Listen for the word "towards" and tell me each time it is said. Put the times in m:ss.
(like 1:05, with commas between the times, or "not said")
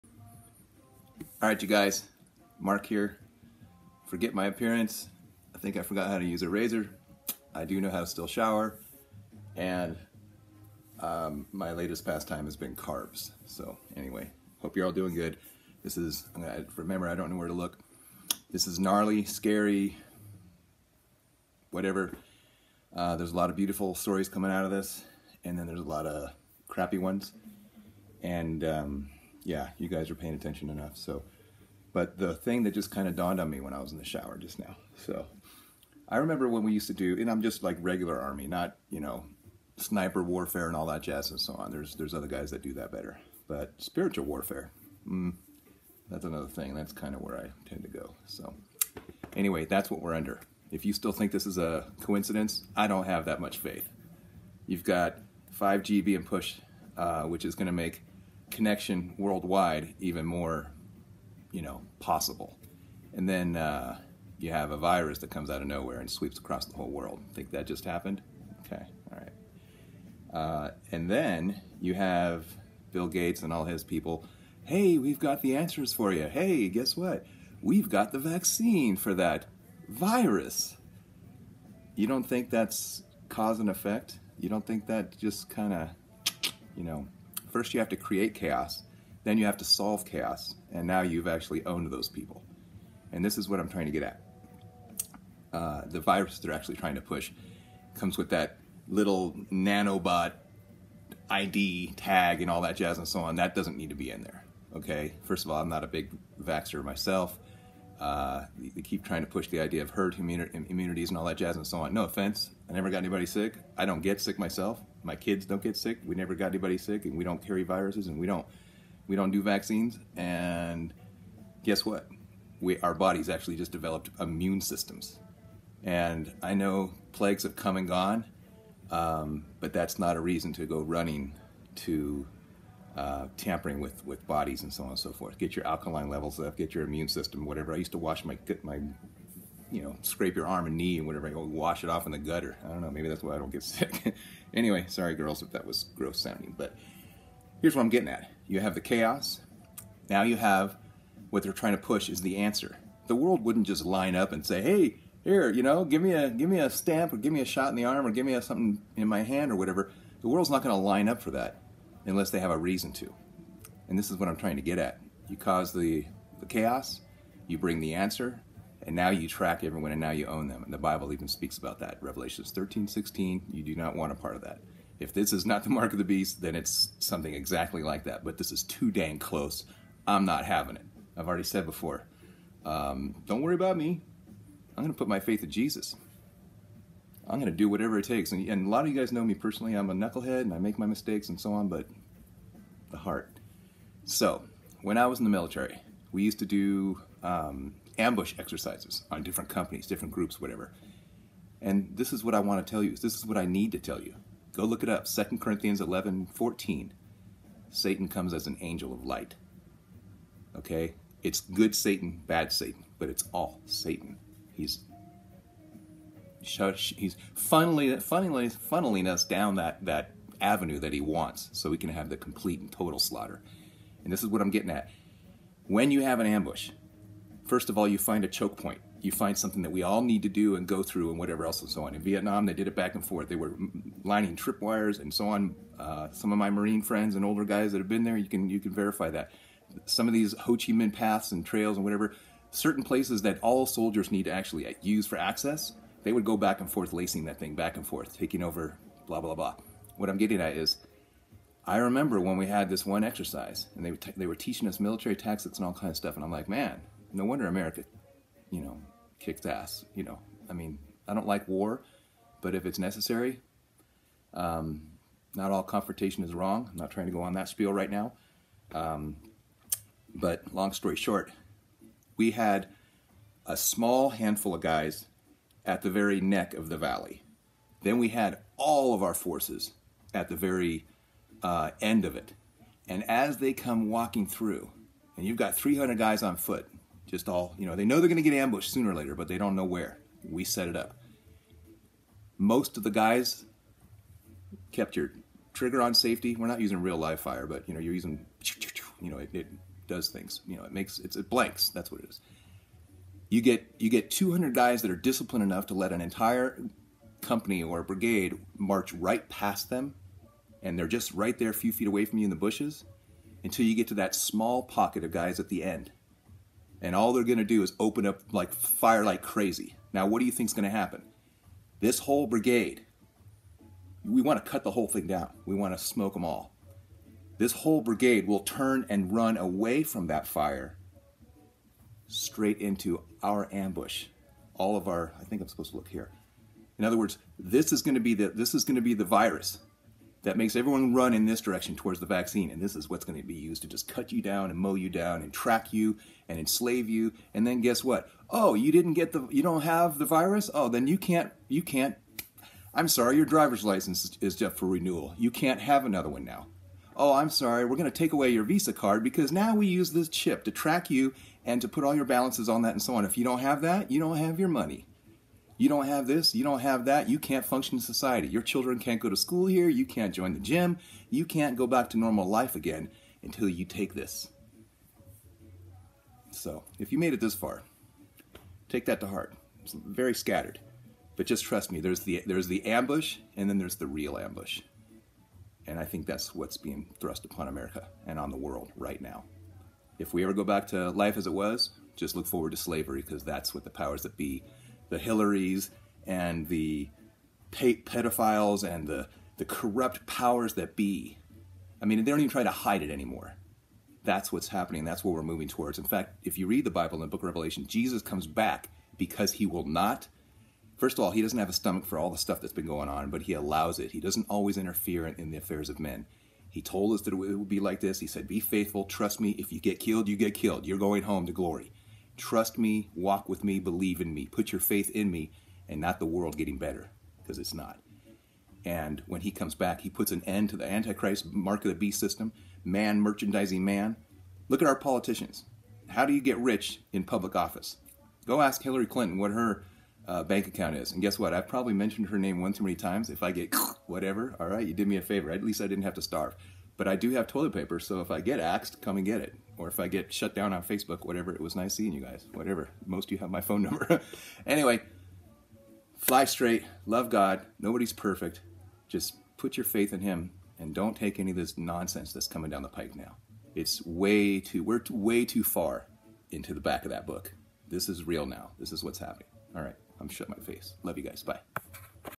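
5:41, 6:45.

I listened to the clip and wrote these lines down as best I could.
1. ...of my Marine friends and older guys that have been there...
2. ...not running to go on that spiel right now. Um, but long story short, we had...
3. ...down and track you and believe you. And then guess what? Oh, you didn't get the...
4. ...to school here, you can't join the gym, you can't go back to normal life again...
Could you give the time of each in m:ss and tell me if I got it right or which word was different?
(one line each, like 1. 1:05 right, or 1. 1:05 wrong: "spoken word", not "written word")
1. 3:56 right
2. 4:26 wrong: "trying", not "running"
3. 5:44 wrong: "enslave", not "believe"
4. 6:09 right.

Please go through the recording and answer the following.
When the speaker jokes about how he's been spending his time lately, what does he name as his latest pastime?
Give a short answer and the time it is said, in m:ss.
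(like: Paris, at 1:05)
carbs, at 0:12.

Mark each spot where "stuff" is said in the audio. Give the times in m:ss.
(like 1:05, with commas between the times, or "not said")
4:15, 6:52.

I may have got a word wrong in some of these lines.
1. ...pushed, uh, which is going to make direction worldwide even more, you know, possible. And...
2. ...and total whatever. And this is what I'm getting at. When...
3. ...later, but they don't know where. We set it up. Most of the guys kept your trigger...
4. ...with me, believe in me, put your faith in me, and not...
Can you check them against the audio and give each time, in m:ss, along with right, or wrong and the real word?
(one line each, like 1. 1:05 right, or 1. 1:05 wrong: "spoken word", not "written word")
1. 0:56 wrong: "connection", not "direction"
2. 3:42 wrong: "slaughter", not "whatever"
3. 4:48 right
4. 7:03 right.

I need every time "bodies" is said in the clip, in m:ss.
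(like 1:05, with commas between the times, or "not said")
2:02, 2:14.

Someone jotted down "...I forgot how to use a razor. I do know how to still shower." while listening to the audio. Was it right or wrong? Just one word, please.
right.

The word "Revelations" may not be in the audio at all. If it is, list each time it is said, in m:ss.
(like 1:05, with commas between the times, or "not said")
2:52, 6:47.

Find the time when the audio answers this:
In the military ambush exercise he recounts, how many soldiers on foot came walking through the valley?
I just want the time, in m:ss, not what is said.
4:45.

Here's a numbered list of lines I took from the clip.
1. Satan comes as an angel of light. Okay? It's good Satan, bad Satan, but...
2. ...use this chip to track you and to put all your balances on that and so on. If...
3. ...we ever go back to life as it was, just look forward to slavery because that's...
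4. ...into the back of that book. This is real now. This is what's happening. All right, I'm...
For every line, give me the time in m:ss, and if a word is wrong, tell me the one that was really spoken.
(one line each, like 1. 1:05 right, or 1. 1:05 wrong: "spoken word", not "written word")
1. 3:27 right
2. 5:59 right
3. 6:30 right
4. 7:46 right.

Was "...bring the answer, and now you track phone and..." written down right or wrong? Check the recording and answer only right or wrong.
wrong.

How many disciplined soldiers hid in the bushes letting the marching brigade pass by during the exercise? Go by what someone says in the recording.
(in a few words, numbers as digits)
200.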